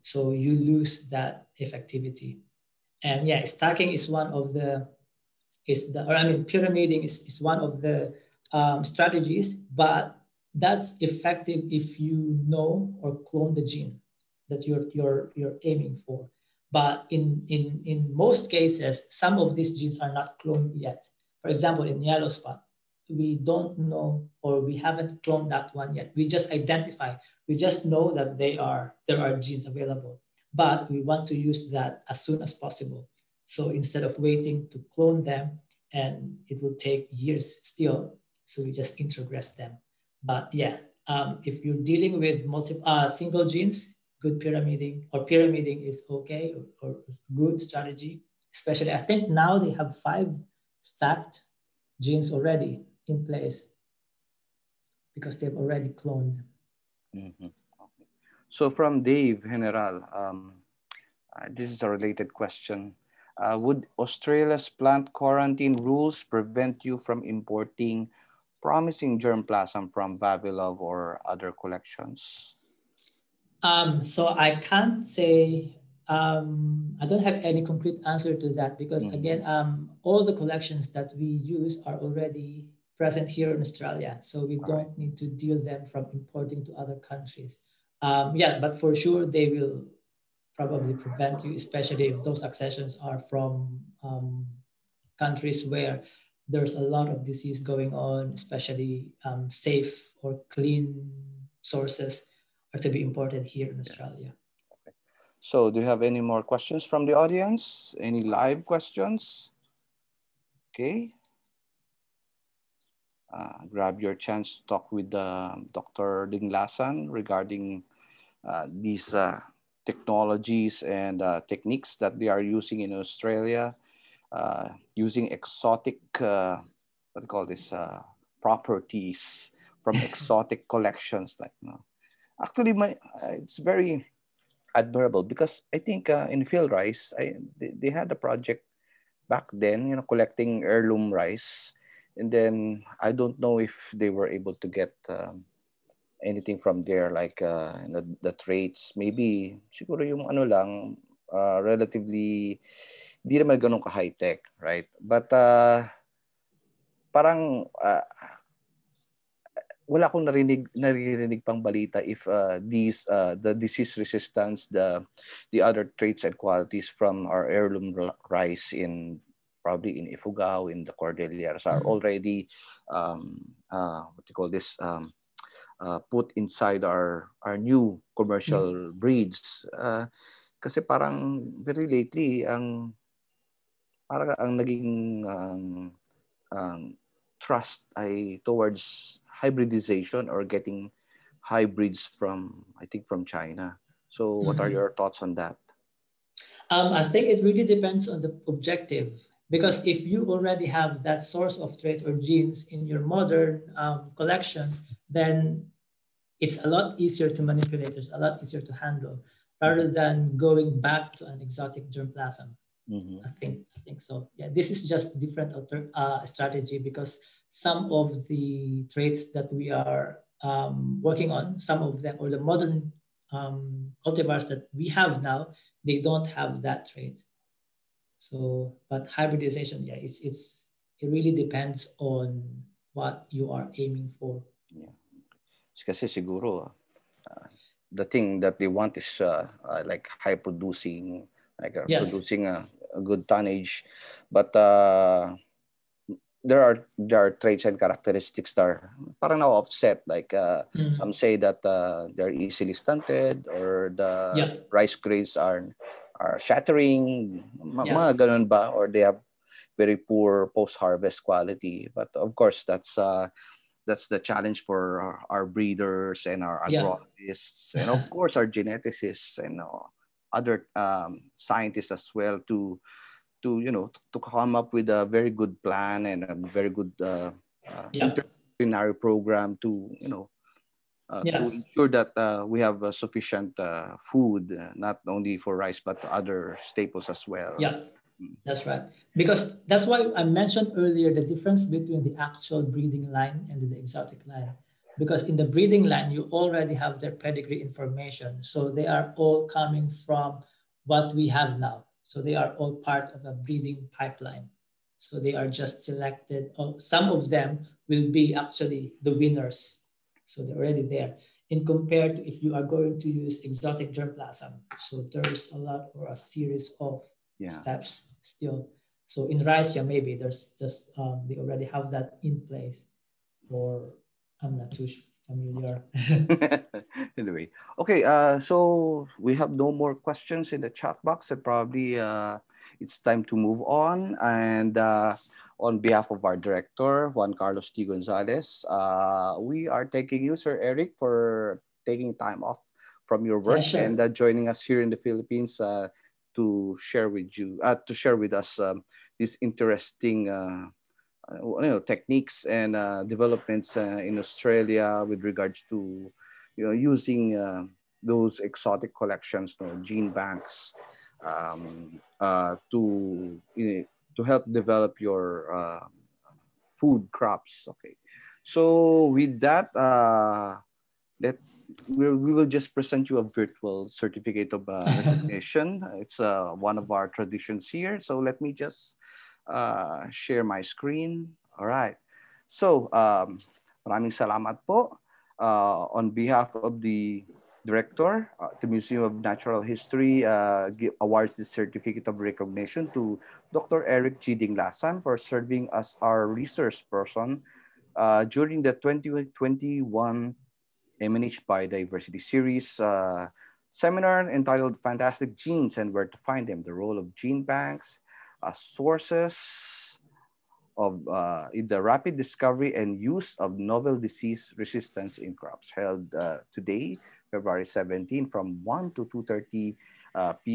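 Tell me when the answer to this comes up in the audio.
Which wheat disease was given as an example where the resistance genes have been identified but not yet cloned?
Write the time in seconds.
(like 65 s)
22 s.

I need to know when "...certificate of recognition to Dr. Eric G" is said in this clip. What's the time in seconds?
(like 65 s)
391 s.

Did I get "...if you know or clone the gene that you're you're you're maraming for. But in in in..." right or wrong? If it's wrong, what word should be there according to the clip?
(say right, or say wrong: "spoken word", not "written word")
wrong: "aiming", not "maraming".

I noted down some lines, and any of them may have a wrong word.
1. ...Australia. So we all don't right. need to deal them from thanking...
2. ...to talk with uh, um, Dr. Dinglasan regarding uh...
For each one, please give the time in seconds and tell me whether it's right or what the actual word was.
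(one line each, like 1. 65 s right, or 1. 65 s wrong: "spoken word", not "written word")
1. 83 s wrong: "importing", not "thanking"
2. 114 s right.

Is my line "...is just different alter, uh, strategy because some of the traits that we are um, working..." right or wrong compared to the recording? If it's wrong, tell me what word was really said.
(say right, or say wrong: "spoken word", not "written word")
right.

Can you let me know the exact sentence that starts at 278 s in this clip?
interdisciplinary program to you know uh, yes.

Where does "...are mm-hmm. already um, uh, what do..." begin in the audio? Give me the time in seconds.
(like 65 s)
171 s.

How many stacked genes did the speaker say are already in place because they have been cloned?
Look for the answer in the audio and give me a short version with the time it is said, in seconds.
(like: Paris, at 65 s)
5, at 49 s.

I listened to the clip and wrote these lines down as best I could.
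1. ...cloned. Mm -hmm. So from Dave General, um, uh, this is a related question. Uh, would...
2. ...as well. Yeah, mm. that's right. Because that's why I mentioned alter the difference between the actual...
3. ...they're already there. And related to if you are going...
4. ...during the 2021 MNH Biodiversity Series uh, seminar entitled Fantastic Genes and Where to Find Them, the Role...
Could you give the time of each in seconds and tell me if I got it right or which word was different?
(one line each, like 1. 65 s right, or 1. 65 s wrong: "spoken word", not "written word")
1. 56 s right
2. 287 s wrong: "earlier", not "alter"
3. 310 s wrong: "compared", not "related"
4. 398 s right.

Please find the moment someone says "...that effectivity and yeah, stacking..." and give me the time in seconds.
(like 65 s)
1 s.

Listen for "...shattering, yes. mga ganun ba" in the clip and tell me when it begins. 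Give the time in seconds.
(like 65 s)
256 s.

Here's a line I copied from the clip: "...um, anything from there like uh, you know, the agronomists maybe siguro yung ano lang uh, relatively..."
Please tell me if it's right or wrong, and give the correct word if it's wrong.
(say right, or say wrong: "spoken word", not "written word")
wrong: "traits", not "agronomists".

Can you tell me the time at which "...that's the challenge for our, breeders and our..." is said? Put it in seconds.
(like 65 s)
263 s.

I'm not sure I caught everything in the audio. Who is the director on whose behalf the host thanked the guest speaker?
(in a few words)
Juan Carlos T. Gonzalez.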